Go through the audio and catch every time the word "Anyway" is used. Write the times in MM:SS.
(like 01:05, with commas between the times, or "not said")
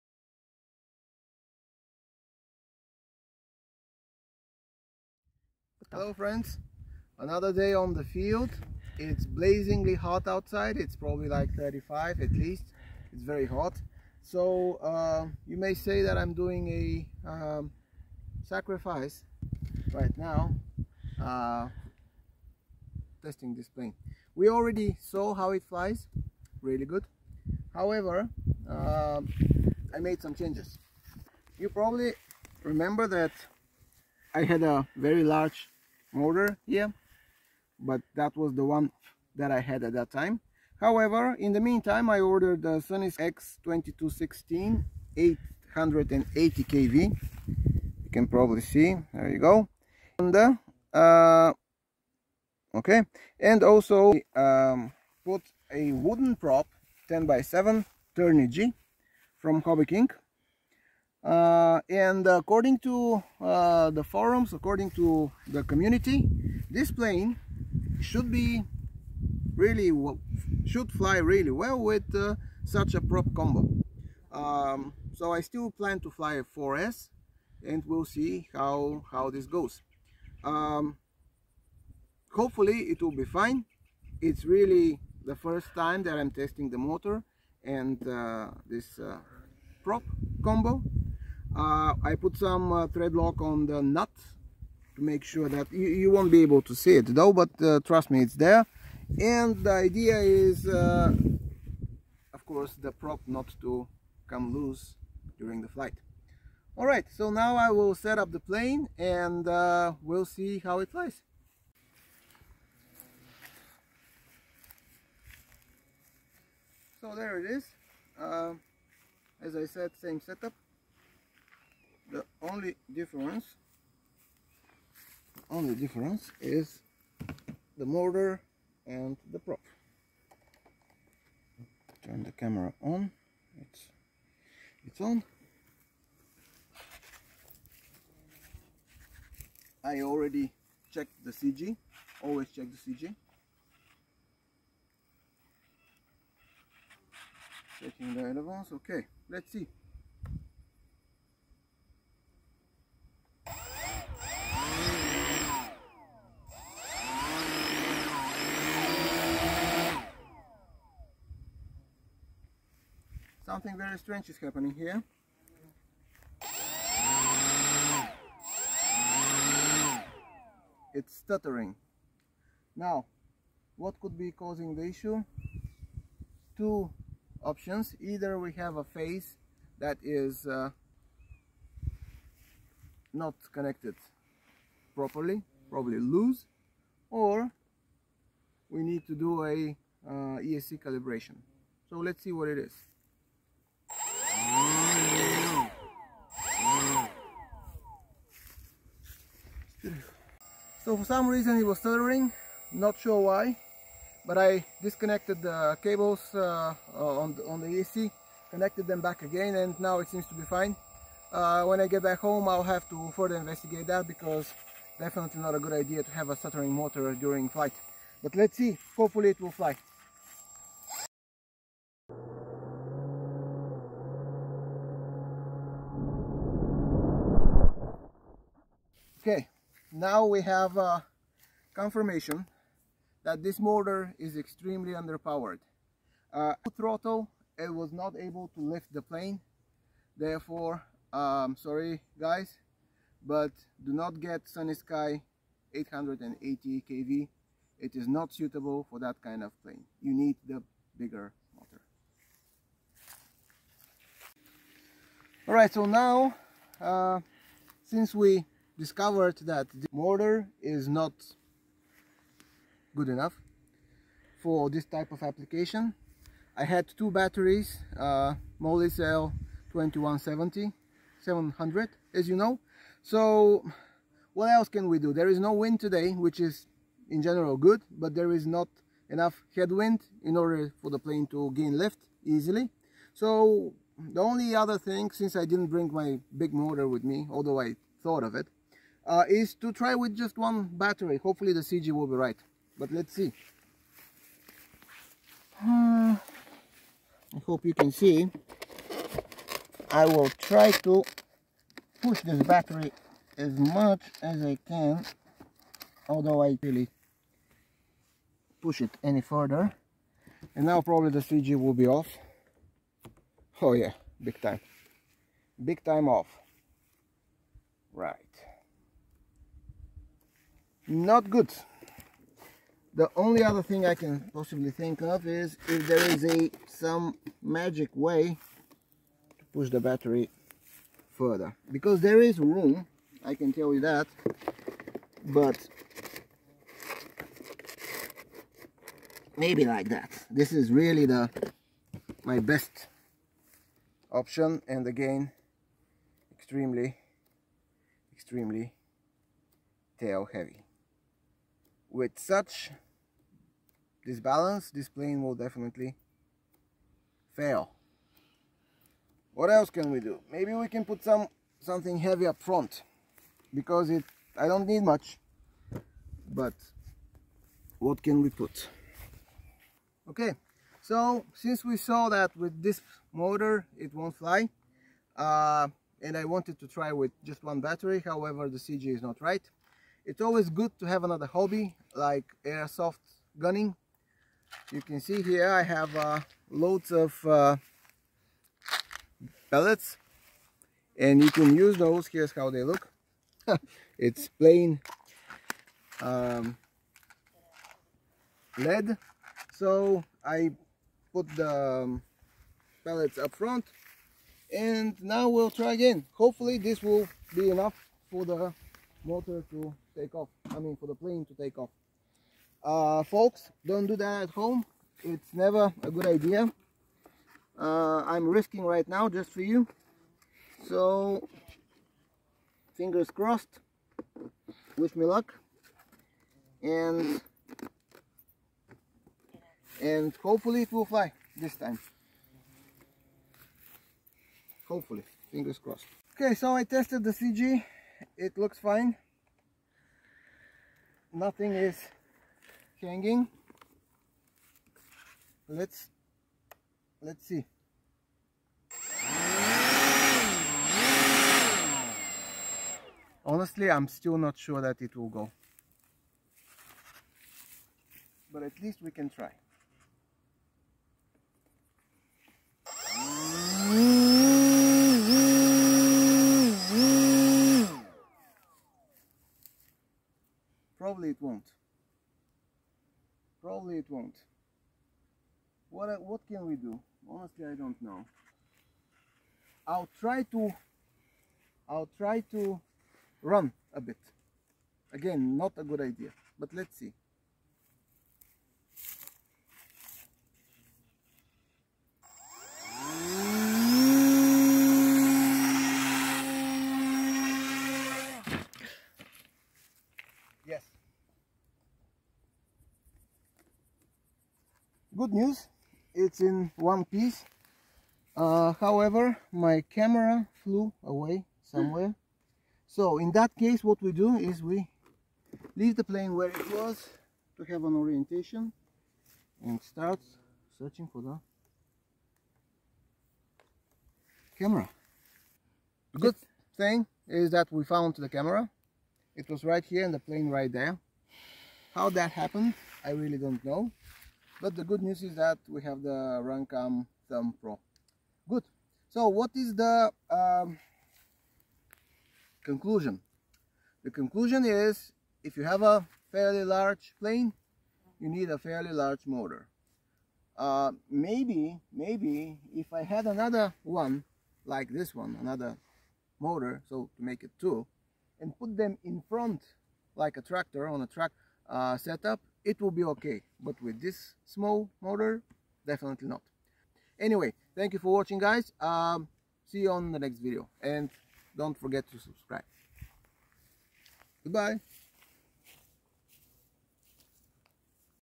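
09:26.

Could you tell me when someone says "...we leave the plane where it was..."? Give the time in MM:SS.
08:34.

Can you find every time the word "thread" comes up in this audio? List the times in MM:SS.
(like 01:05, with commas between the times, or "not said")
01:32.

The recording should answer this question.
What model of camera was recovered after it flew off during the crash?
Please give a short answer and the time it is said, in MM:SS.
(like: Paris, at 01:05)
Runcam Thumb Pro, at 08:56.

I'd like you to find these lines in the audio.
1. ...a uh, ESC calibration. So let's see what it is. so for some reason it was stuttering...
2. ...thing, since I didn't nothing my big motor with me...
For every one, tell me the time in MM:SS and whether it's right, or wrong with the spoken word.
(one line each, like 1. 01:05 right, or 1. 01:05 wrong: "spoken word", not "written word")
1. 03:09 right
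2. 04:44 wrong: "bring", not "nothing".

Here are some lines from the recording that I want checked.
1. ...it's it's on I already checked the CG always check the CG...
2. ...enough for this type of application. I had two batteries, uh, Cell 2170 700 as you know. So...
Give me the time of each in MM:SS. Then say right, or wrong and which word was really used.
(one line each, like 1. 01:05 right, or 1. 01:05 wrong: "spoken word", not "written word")
1. 02:13 right
2. 04:23 right.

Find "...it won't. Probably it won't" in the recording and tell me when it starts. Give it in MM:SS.
07:51.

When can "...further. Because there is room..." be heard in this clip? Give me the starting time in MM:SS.
05:31.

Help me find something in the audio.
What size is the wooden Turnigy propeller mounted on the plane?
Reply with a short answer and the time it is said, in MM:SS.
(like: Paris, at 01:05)
10 by 7, at 00:57.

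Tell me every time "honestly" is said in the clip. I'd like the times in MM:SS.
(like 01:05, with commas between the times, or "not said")
07:33, 07:57.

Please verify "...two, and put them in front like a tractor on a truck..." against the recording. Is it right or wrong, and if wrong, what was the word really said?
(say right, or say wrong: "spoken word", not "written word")
right.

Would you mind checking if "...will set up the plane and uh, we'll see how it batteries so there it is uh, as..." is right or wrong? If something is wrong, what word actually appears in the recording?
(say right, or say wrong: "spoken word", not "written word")
wrong: "flies", not "batteries".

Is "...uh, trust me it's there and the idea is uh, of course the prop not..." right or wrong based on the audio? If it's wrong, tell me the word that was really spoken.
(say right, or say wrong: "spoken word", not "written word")
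right.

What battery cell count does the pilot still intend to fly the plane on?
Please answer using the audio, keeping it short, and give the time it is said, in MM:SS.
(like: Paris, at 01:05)
4S, at 01:16.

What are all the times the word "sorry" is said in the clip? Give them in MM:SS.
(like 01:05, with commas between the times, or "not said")
04:01.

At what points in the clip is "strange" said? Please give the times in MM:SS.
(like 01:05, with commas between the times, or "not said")
02:43.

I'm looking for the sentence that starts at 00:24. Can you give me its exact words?
We already saw how it flies, really good.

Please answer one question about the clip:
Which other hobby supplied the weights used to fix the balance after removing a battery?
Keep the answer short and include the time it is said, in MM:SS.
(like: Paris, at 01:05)
airsoft, at 06:22.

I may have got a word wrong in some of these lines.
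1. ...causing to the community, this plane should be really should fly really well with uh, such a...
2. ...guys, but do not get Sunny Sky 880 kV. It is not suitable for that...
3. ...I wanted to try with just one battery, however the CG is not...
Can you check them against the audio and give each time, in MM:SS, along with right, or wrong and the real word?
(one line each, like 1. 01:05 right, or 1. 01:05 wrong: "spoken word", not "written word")
1. 01:04 wrong: "according", not "causing"
2. 04:02 right
3. 06:16 right.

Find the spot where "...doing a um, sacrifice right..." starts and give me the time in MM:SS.
00:16.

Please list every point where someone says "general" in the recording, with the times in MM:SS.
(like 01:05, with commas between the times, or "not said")
04:37.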